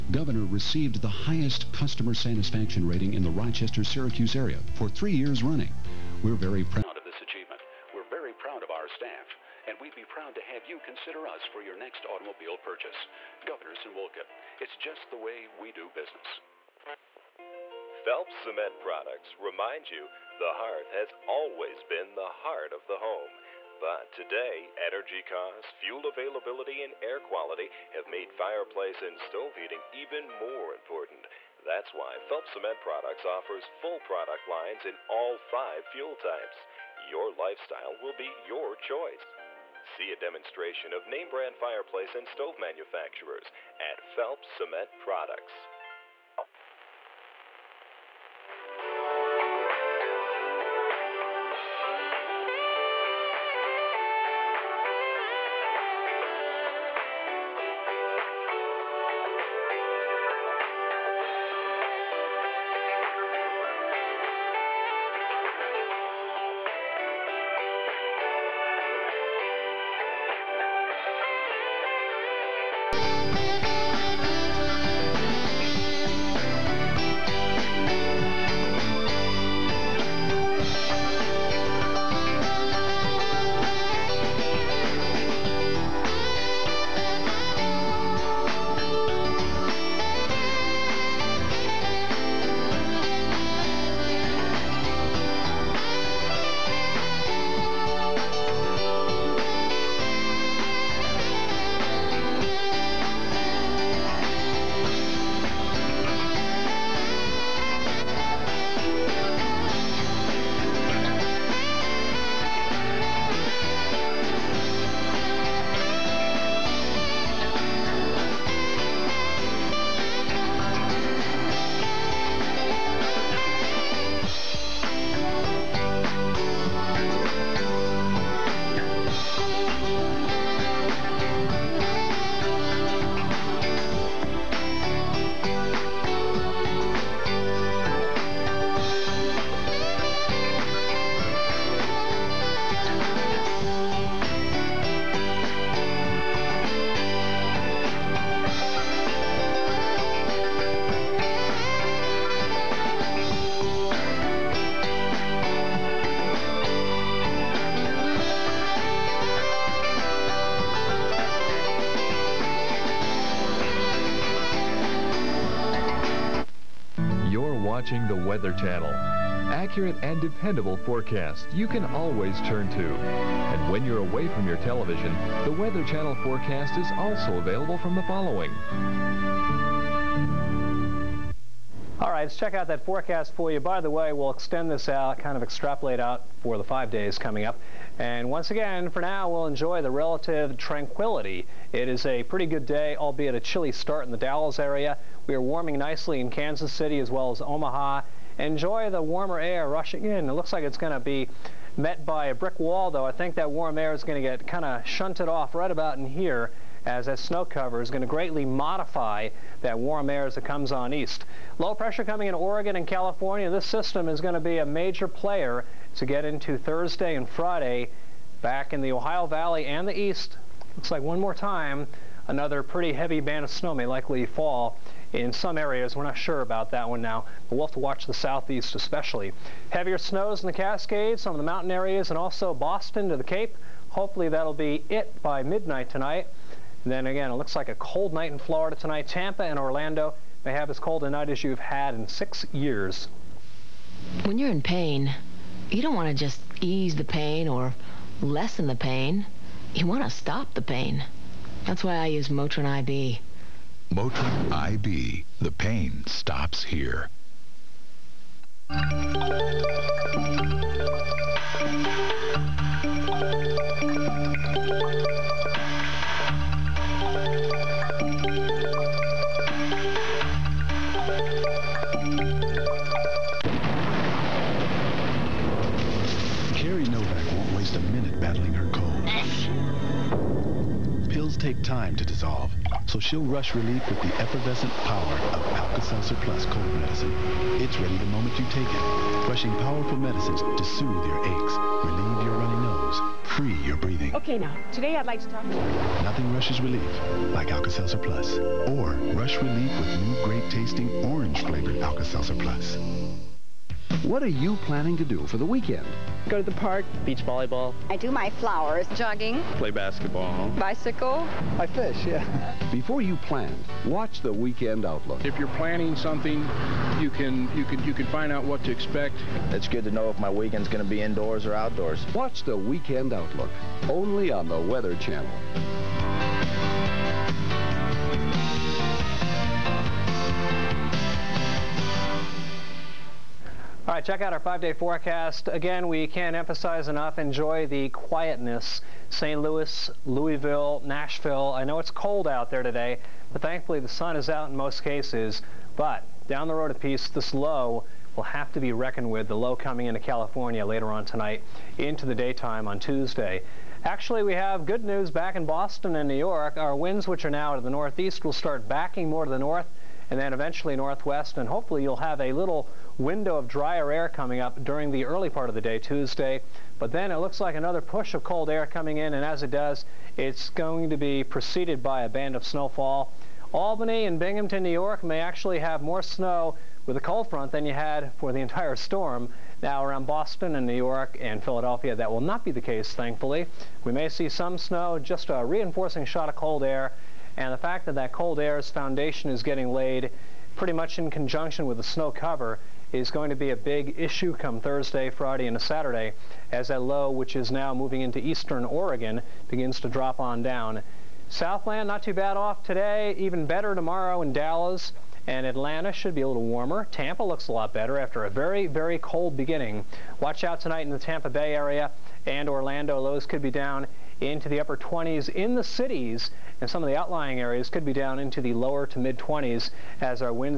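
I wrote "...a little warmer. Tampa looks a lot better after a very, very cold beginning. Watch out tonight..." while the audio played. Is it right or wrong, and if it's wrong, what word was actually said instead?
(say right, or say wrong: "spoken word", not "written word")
right.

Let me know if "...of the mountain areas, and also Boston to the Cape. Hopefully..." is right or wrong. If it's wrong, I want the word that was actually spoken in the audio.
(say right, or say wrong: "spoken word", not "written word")
right.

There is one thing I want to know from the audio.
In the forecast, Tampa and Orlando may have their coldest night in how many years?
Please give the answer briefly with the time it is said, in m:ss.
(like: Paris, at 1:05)
6, at 4:02.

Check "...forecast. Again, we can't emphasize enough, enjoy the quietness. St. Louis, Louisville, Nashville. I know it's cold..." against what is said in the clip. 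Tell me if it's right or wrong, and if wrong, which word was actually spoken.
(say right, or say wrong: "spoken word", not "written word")
right.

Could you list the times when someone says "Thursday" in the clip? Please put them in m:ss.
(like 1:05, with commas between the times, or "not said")
3:36, 6:34.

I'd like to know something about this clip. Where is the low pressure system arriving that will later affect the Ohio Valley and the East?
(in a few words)
Oregon and California.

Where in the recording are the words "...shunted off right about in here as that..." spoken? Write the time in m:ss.
3:24.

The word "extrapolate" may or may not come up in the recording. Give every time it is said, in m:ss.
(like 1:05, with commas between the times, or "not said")
3:05.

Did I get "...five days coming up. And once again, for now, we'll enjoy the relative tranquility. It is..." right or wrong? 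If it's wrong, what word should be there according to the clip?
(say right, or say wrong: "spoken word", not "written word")
right.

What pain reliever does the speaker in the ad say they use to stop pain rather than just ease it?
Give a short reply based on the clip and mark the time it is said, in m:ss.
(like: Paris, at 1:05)
Motrin IB, at 4:12.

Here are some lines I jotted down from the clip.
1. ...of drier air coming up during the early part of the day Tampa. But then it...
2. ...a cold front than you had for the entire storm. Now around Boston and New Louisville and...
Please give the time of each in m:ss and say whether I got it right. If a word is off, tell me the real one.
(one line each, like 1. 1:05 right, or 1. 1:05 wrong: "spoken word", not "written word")
1. 6:03 wrong: "Tuesday", not "Tampa"
2. 6:16 wrong: "York", not "Louisville".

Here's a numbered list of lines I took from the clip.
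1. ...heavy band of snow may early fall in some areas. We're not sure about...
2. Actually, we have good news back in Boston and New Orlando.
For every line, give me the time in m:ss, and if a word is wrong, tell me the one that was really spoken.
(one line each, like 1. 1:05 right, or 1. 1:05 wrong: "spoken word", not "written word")
1. 3:42 wrong: "likely", not "early"
2. 5:53 wrong: "York", not "Orlando".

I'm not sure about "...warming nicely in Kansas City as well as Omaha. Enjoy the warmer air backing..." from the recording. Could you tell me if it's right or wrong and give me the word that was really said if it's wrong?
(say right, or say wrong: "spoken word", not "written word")
wrong: "rushing", not "backing".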